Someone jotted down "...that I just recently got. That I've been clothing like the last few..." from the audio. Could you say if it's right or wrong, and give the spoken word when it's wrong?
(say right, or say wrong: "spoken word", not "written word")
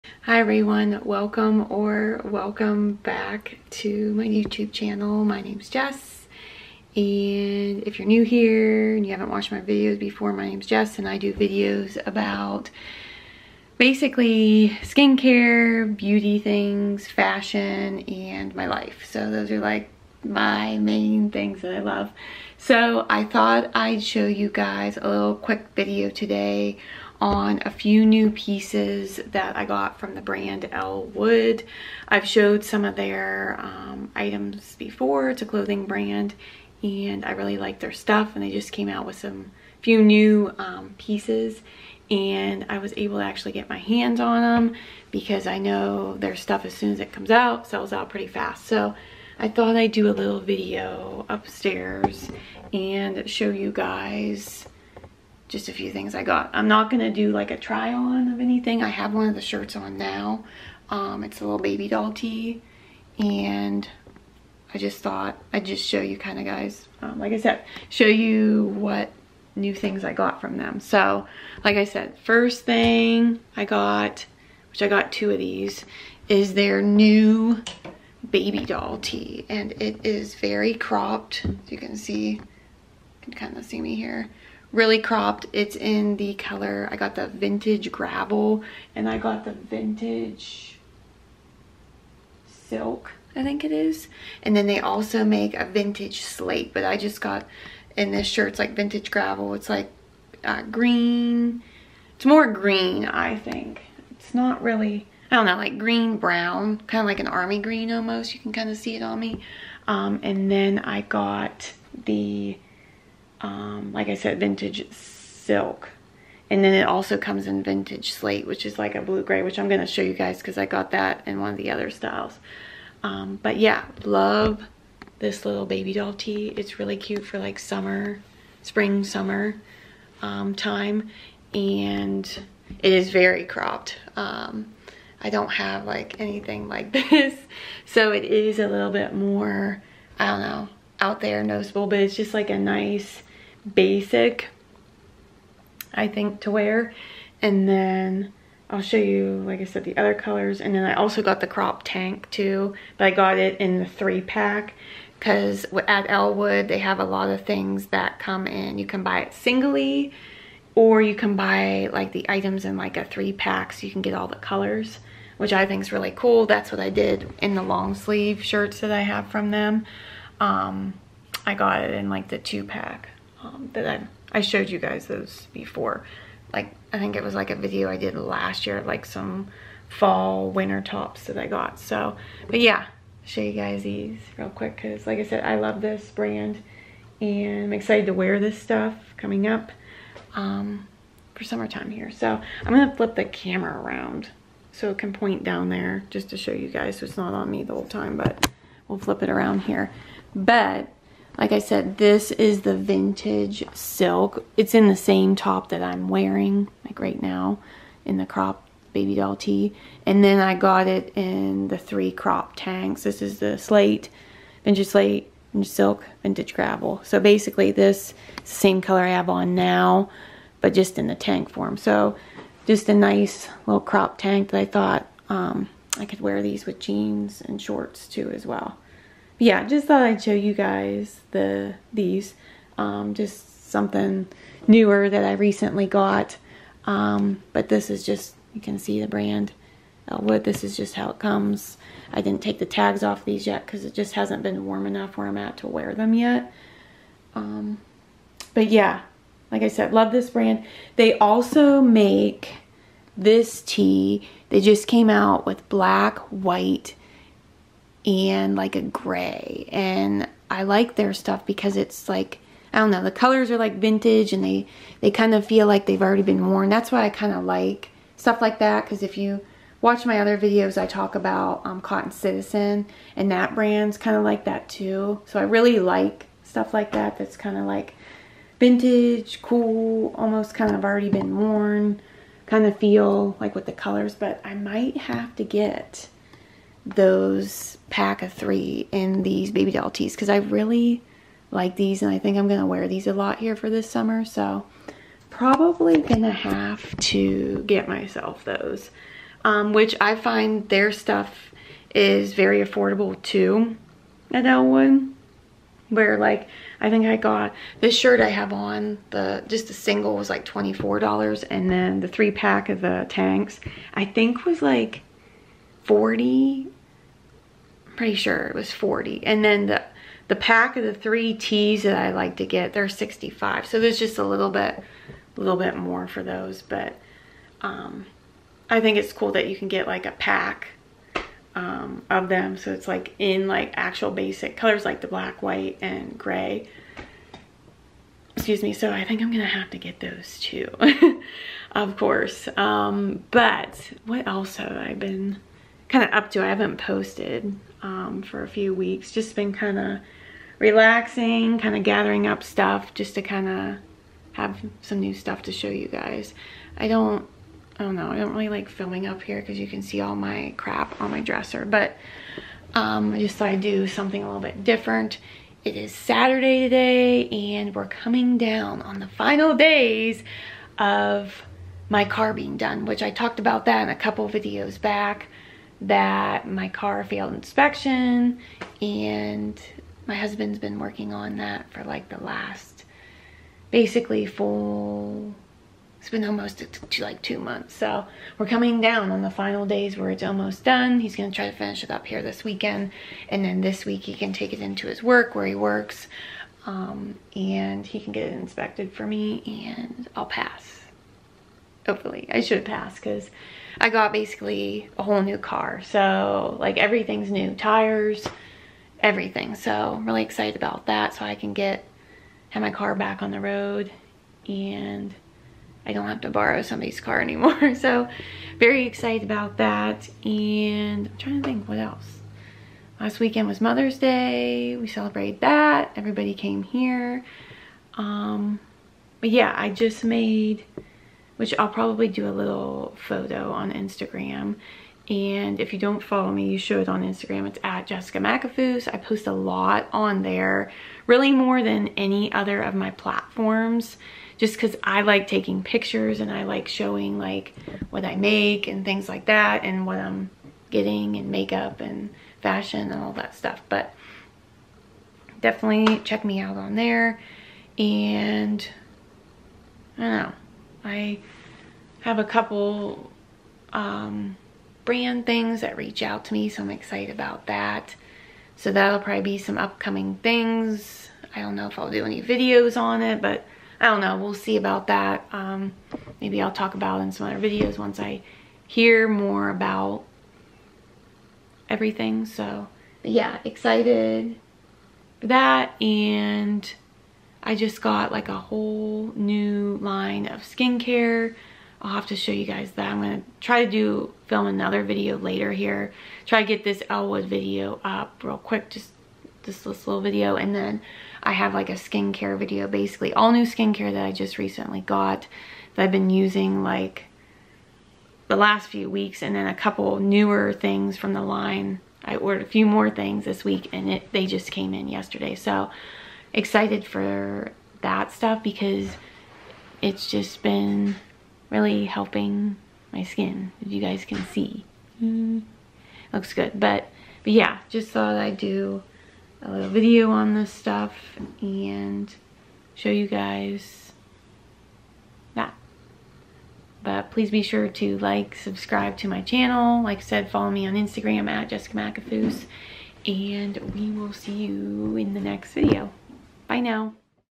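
wrong: "using", not "clothing".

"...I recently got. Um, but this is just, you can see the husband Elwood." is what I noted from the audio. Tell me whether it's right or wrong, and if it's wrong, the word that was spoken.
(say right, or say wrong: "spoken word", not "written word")
wrong: "brand", not "husband".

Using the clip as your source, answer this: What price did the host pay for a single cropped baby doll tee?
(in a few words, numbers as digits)
$24.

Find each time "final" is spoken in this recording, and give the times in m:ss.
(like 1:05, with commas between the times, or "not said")
6:09, 6:29.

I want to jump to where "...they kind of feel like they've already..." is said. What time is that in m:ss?
4:25.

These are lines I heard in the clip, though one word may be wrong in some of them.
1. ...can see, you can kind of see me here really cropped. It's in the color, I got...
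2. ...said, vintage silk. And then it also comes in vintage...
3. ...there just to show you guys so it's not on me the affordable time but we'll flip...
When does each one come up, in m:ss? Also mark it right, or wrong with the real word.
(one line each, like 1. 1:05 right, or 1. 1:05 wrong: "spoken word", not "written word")
1. 1:21 right
2. 1:54 right
3. 3:15 wrong: "whole", not "affordable".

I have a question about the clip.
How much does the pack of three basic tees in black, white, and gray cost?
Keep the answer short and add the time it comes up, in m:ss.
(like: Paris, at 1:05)
$65, at 5:22.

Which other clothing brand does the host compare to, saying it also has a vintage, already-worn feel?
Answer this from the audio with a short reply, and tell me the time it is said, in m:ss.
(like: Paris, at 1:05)
Cotton Citizen, at 4:31.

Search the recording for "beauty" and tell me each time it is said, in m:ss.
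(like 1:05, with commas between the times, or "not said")
0:15.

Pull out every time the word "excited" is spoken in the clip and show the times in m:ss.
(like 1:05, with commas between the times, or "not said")
3:07, 6:50, 6:58, 7:46, 8:03, 8:36.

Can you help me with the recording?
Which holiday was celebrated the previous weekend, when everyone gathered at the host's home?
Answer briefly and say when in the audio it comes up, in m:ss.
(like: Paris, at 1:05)
Mother's Day, at 7:03.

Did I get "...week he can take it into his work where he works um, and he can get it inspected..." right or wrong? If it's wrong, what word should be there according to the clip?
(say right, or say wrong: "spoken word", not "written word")
right.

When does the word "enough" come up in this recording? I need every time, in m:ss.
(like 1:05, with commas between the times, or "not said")
4:04.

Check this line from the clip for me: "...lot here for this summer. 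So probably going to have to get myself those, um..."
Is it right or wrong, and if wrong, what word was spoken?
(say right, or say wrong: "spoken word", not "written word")
right.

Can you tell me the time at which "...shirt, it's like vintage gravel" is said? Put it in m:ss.
1:38.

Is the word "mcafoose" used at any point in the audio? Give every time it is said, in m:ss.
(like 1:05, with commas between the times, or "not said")
7:18, 9:01.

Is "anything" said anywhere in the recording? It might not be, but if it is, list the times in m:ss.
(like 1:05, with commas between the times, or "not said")
0:58, 2:16.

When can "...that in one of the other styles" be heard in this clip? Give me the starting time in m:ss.
2:00.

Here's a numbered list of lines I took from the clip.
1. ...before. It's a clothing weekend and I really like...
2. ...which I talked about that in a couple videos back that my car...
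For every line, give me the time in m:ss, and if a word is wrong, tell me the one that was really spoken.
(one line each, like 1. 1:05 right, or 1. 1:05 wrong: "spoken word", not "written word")
1. 0:34 wrong: "brand", not "weekend"
2. 6:12 right.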